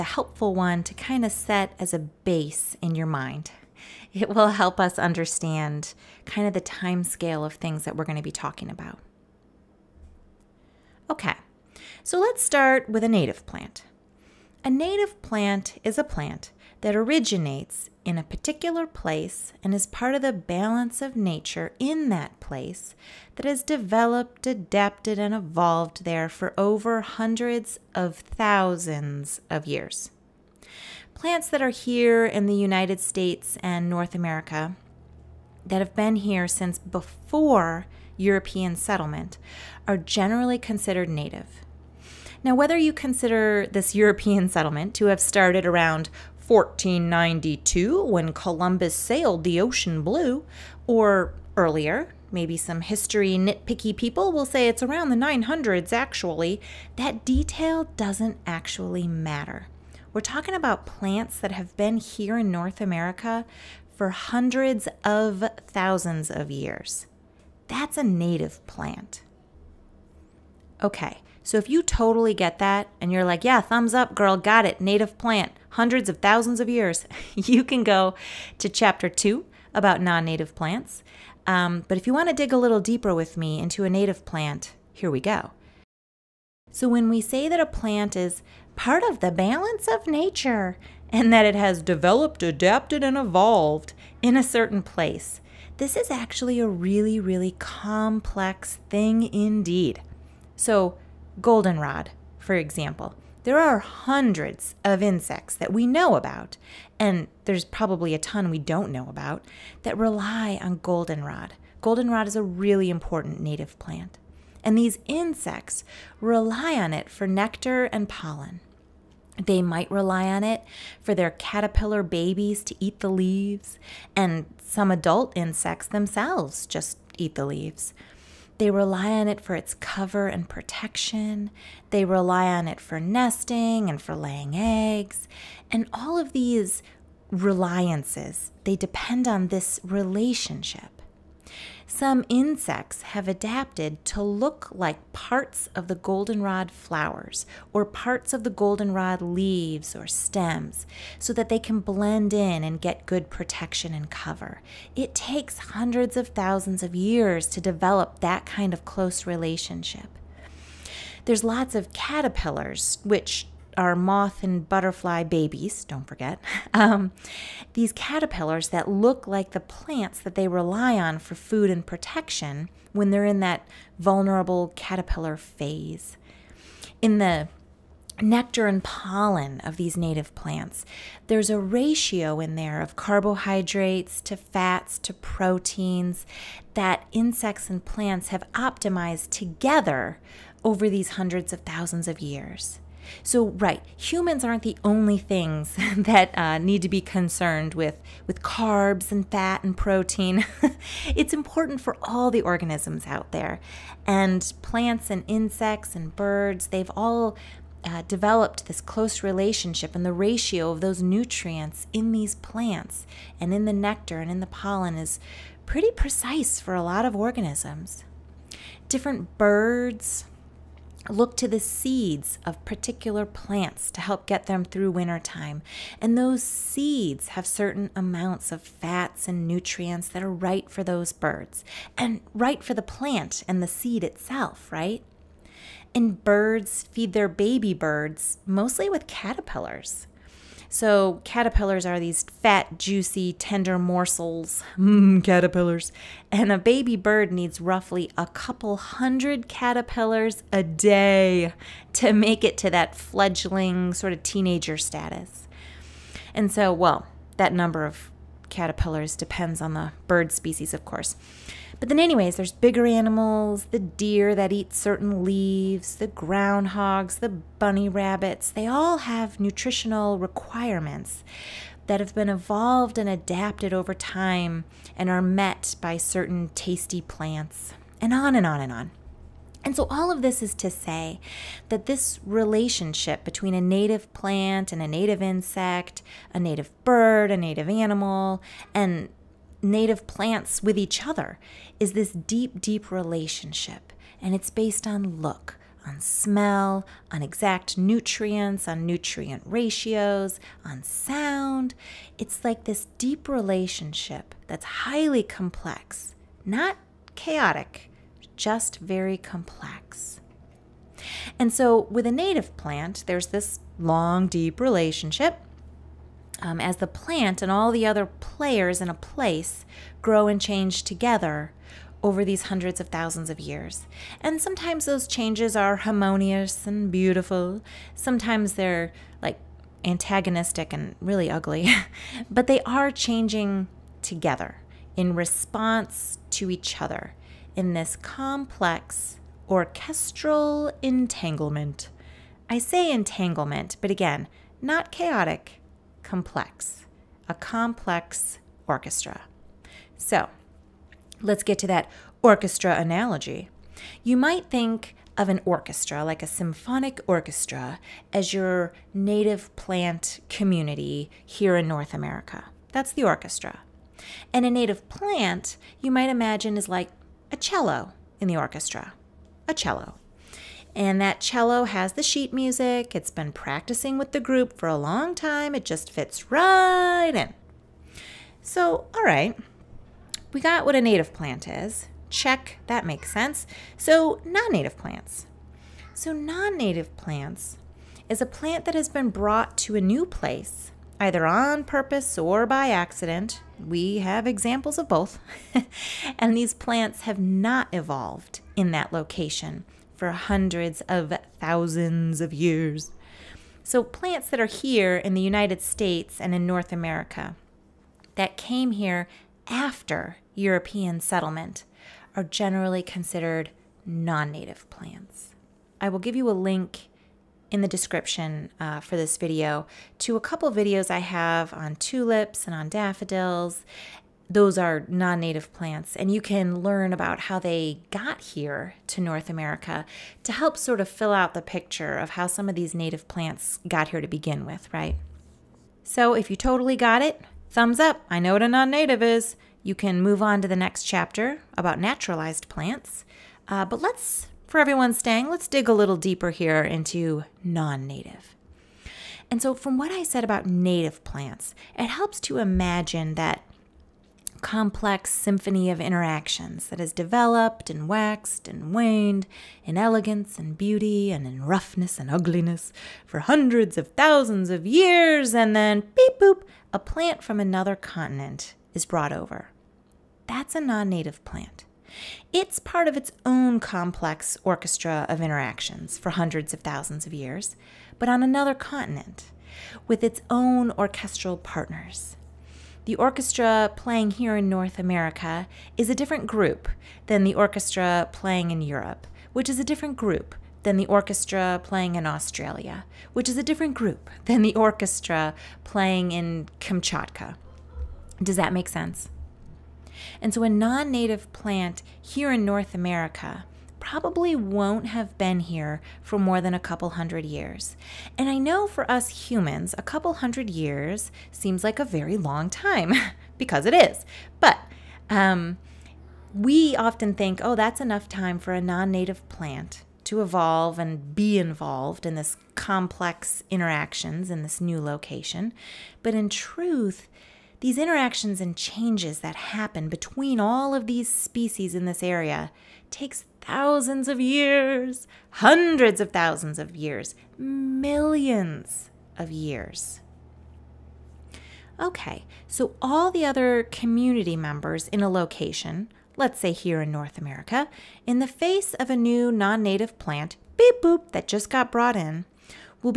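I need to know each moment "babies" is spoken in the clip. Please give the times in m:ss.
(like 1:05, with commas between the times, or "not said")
2:02, 2:45.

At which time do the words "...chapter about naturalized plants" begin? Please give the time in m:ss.
7:20.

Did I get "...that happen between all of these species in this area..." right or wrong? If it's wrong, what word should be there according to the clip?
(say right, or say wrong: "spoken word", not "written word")
right.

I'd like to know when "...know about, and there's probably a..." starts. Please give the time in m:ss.
1:45.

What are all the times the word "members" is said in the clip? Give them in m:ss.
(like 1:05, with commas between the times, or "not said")
9:04.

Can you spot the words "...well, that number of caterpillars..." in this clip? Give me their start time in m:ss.
4:16.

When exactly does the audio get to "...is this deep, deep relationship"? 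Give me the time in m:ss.
4:51.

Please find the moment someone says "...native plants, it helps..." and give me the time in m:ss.
7:30.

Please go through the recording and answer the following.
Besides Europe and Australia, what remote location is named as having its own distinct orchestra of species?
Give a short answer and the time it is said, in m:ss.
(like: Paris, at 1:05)
Kamchatka, at 8:16.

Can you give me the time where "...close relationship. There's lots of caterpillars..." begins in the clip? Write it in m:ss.
2:38.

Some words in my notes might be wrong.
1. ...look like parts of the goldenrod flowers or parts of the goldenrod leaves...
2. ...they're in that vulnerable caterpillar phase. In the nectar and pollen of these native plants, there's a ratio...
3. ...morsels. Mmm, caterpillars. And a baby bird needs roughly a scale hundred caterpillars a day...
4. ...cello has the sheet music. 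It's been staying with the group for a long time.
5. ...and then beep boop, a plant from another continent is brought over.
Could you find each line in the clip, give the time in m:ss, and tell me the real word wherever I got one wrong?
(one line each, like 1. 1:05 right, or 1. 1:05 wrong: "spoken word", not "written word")
1. 2:24 right
2. 2:53 right
3. 4:03 wrong: "couple", not "scale"
4. 6:11 wrong: "practicing", not "staying"
5. 7:45 right.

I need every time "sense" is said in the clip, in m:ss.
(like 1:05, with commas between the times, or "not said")
6:23, 8:18.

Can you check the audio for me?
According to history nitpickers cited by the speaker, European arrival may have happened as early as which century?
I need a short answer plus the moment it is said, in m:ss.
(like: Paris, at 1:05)
the 900s, at 0:55.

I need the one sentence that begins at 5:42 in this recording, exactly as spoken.
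I say entanglement, but again, not chaotic complex, a complex orchestra.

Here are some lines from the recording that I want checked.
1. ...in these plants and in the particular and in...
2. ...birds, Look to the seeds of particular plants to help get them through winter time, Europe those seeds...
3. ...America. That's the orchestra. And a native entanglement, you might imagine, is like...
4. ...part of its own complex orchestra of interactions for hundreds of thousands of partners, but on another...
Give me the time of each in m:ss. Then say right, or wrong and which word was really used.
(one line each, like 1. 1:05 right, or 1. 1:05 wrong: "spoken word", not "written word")
1. 3:31 wrong: "nectar", not "particular"
2. 3:39 wrong: "And", not "Europe"
3. 6:01 wrong: "plant", not "entanglement"
4. 7:52 wrong: "years", not "partners".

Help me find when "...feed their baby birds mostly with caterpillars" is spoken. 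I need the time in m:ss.
3:56.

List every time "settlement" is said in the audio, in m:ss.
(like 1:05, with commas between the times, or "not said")
0:38, 0:44, 6:51.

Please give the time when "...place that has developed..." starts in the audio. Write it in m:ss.
0:22.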